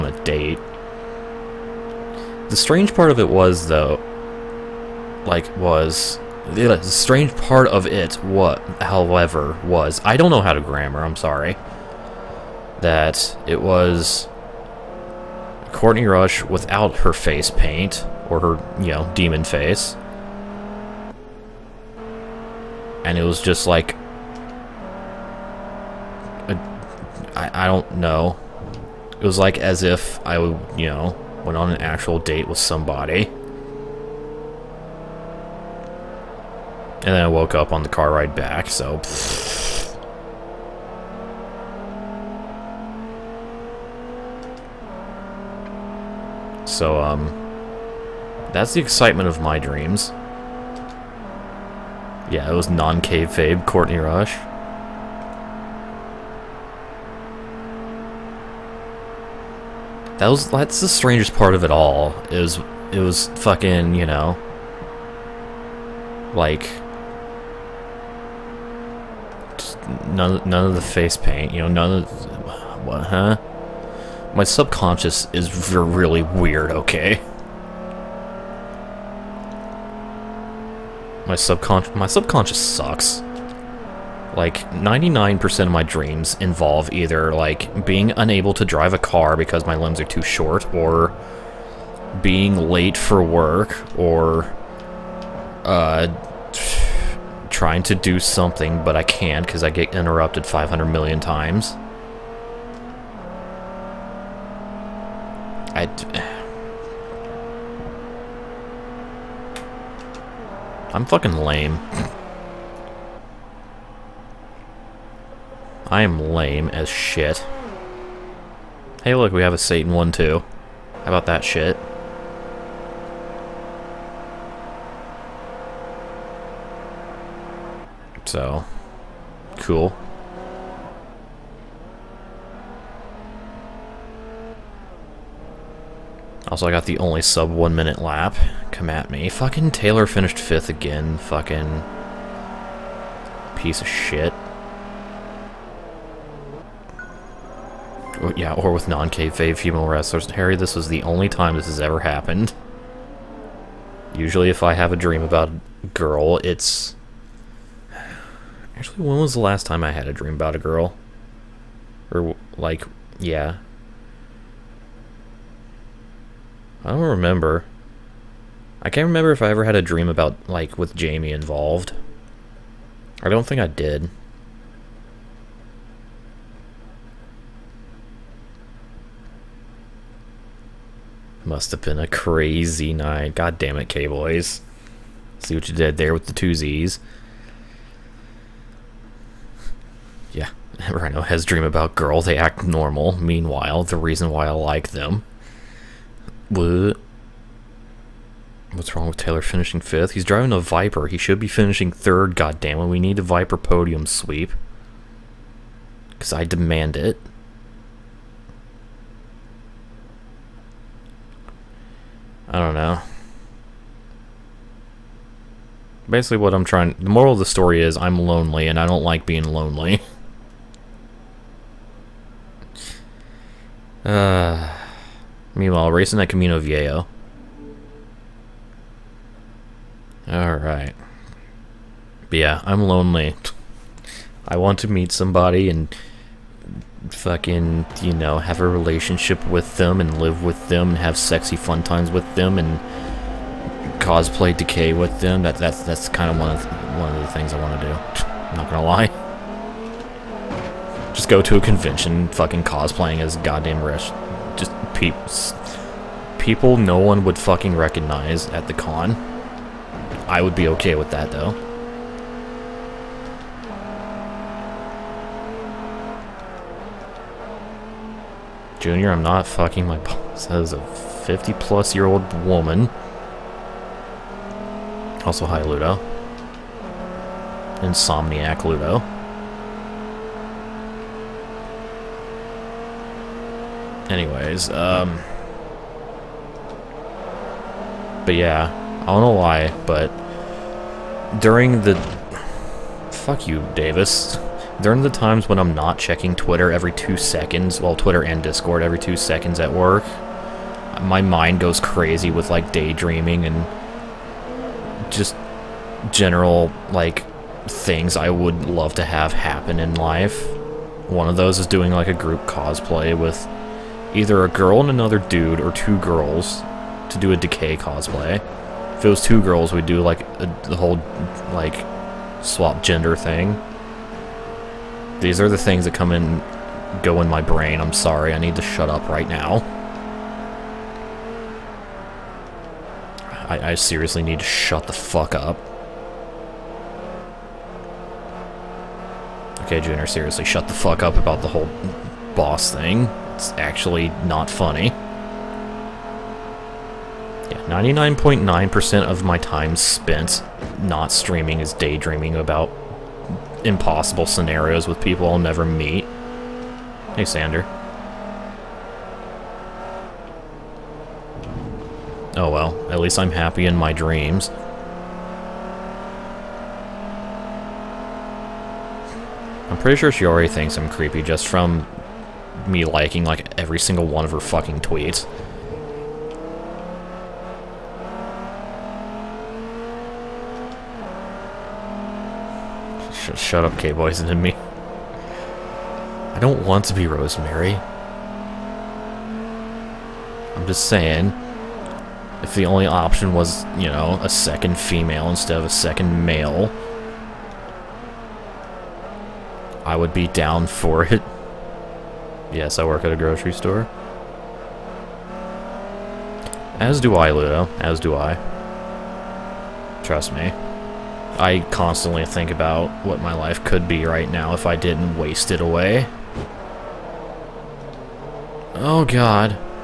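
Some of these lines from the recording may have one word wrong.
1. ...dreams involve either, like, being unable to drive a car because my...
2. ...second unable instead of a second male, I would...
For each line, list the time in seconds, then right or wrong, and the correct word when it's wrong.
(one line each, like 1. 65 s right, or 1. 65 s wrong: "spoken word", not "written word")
1. 85 s right
2. 394 s wrong: "female", not "unable".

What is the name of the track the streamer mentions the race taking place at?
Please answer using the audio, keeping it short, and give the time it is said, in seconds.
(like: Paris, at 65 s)
Camino Viejo, at 226 s.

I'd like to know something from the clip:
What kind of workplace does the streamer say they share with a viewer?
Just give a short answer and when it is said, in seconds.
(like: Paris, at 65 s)
grocery store, at 403 s.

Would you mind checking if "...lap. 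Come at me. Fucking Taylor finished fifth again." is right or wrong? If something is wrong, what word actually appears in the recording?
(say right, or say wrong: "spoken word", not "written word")
right.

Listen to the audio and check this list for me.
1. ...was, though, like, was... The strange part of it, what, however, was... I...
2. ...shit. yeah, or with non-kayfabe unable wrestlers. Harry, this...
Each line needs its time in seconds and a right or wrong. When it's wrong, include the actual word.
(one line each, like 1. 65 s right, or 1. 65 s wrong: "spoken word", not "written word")
1. 3 s right
2. 143 s wrong: "female", not "unable".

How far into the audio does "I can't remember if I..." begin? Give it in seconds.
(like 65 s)
168 s.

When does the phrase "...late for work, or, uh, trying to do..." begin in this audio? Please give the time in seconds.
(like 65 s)
92 s.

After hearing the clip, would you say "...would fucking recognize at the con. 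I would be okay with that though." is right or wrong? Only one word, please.
right.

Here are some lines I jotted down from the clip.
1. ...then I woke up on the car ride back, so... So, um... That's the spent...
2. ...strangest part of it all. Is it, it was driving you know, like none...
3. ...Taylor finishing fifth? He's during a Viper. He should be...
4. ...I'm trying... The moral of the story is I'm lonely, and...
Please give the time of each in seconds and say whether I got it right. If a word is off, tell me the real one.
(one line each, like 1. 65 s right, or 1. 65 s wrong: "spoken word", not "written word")
1. 37 s wrong: "excitement", not "spent"
2. 60 s wrong: "fucking", not "driving"
3. 199 s wrong: "driving", not "during"
4. 216 s right.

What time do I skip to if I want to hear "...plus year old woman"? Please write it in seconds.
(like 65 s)
271 s.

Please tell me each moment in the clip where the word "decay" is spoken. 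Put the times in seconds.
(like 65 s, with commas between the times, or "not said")
244 s, 317 s.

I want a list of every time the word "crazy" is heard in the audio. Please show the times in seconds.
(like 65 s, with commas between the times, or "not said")
182 s, 301 s.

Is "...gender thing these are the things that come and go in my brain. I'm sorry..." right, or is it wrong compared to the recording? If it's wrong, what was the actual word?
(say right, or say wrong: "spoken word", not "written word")
right.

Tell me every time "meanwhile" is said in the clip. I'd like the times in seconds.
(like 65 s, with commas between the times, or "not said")
193 s, 225 s.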